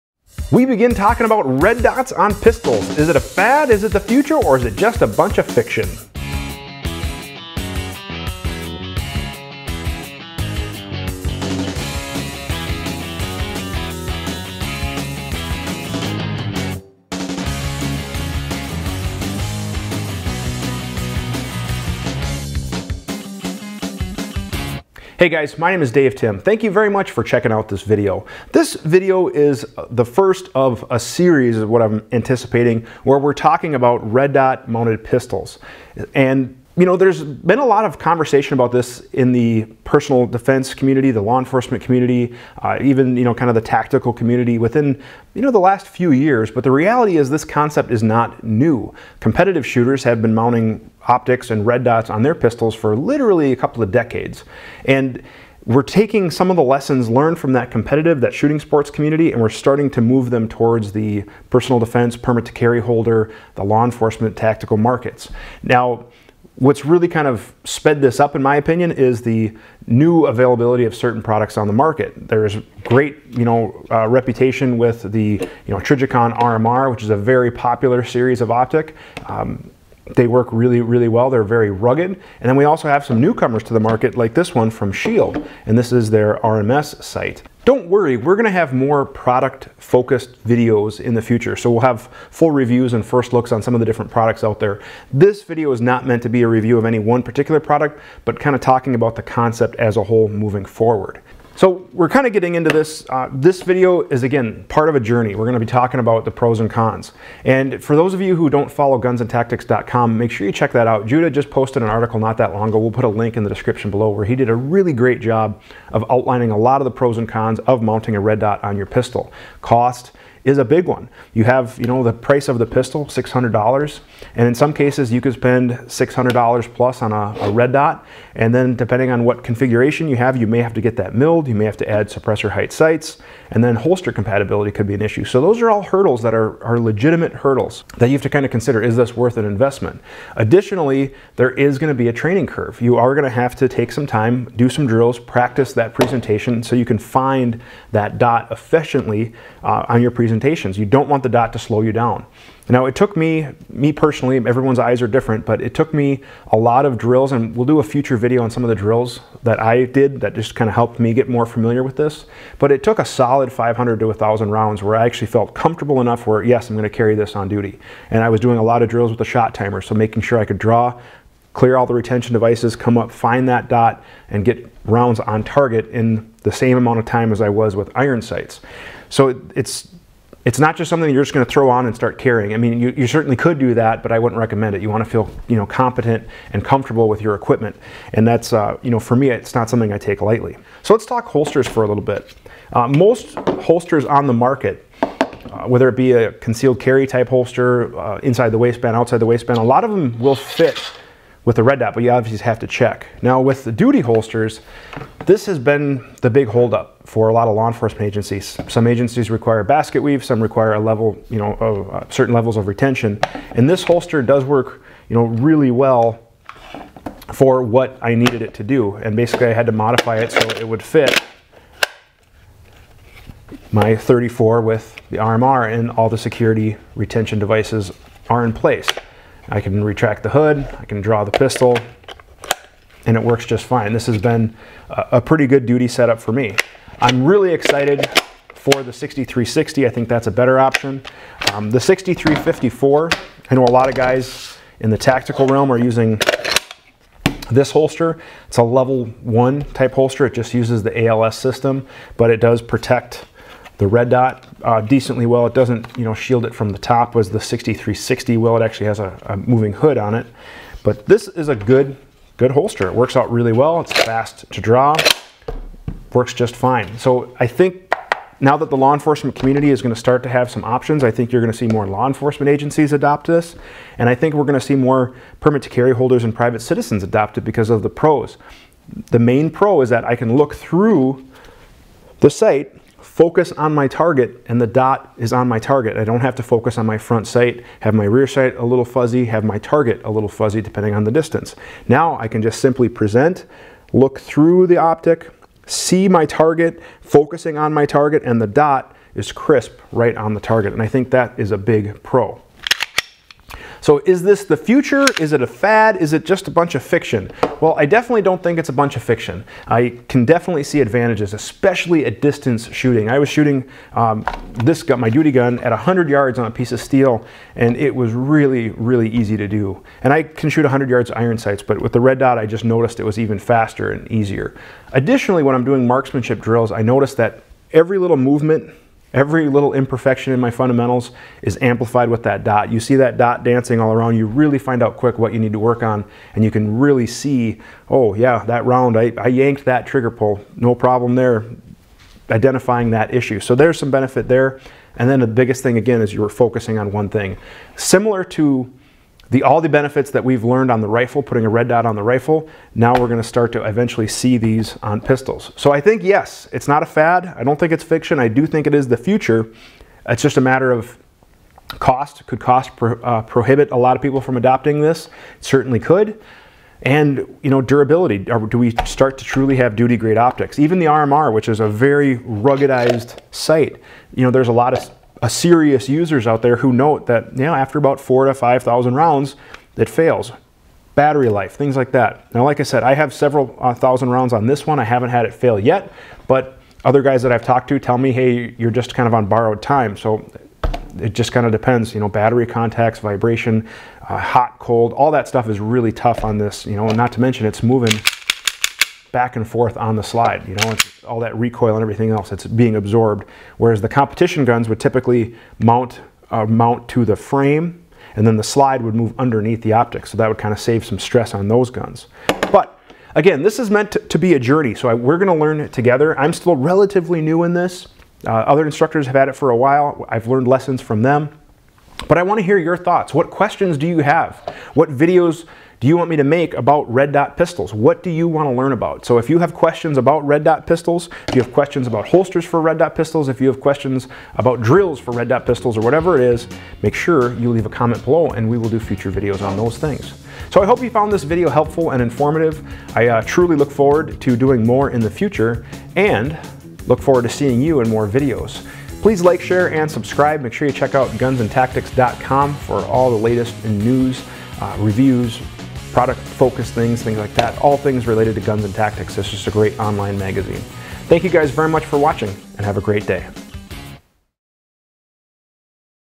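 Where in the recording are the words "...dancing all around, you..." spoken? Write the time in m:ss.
5:33.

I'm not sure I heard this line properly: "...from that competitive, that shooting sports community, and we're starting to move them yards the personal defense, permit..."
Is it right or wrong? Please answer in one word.
wrong.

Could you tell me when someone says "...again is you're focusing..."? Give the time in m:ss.
5:45.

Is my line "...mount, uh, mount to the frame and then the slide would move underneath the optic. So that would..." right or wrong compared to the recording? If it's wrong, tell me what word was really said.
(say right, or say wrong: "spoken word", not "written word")
right.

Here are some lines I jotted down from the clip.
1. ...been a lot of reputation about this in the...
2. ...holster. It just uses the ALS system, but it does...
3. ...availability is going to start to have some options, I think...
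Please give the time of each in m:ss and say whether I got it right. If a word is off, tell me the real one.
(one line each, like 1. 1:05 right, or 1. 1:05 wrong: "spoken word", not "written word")
1. 0:37 wrong: "conversation", not "reputation"
2. 4:09 right
3. 4:29 wrong: "community", not "availability".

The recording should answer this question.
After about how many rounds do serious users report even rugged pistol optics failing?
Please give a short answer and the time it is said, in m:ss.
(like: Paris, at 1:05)
4,000 to 5,000, at 6:17.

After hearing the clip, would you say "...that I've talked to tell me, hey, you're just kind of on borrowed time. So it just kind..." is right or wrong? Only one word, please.
right.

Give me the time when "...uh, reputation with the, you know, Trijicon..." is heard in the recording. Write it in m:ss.
1:13.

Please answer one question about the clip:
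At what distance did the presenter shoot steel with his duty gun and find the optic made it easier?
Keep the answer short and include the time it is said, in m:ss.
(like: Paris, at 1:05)
100 yards, at 5:15.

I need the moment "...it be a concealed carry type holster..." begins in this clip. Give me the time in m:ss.
3:15.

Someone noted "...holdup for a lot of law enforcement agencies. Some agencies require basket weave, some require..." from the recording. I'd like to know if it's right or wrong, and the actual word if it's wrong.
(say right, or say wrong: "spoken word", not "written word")
right.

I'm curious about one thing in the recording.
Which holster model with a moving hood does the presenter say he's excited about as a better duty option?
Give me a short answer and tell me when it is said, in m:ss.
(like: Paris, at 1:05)
6360, at 3:56.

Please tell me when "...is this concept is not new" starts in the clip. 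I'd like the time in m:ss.
0:47.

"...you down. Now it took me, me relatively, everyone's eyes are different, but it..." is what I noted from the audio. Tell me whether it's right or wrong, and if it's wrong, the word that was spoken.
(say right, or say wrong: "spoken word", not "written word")
wrong: "personally", not "relatively".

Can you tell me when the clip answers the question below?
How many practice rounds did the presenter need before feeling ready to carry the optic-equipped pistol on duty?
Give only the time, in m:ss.
2:43.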